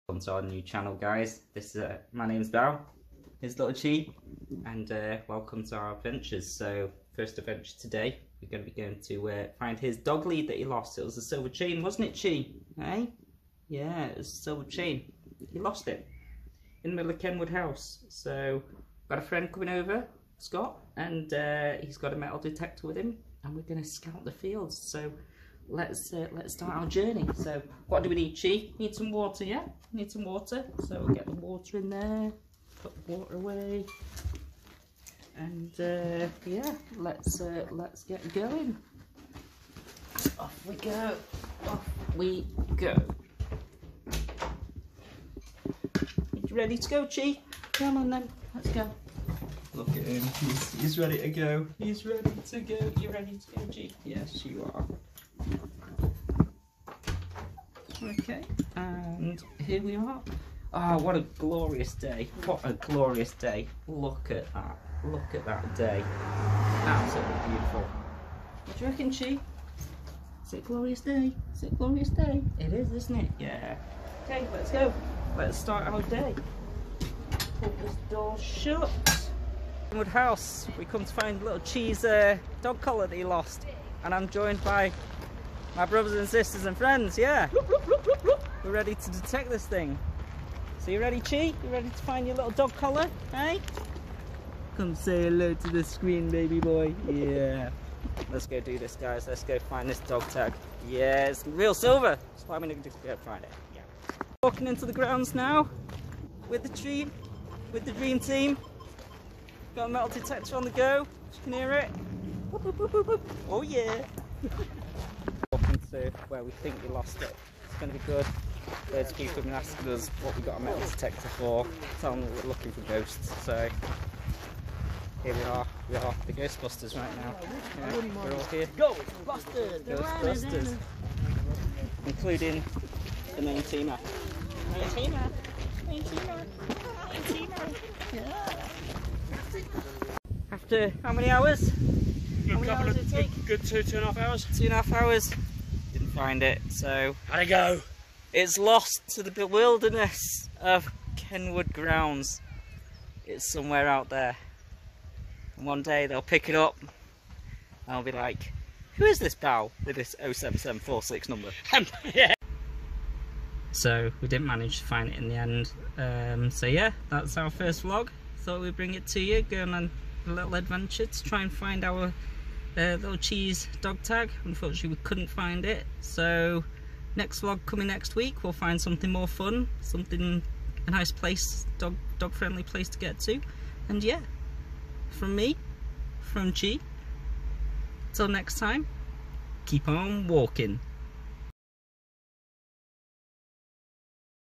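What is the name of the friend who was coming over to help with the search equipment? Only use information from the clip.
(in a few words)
Scott.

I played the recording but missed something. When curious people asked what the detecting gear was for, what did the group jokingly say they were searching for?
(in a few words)
Ghosts.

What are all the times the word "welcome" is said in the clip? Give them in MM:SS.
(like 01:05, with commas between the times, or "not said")
00:00, 00:05.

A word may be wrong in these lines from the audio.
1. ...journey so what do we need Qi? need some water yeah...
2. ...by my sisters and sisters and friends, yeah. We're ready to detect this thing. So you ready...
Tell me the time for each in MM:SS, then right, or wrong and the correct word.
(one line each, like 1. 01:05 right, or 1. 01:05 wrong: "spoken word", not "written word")
1. 00:26 right
2. 01:24 wrong: "brothers", not "sisters".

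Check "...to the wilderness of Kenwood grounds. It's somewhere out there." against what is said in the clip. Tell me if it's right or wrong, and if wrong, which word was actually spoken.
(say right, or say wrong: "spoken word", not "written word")
right.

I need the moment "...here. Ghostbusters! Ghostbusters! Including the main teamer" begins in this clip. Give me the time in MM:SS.
02:08.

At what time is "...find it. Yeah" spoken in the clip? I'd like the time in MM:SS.
01:43.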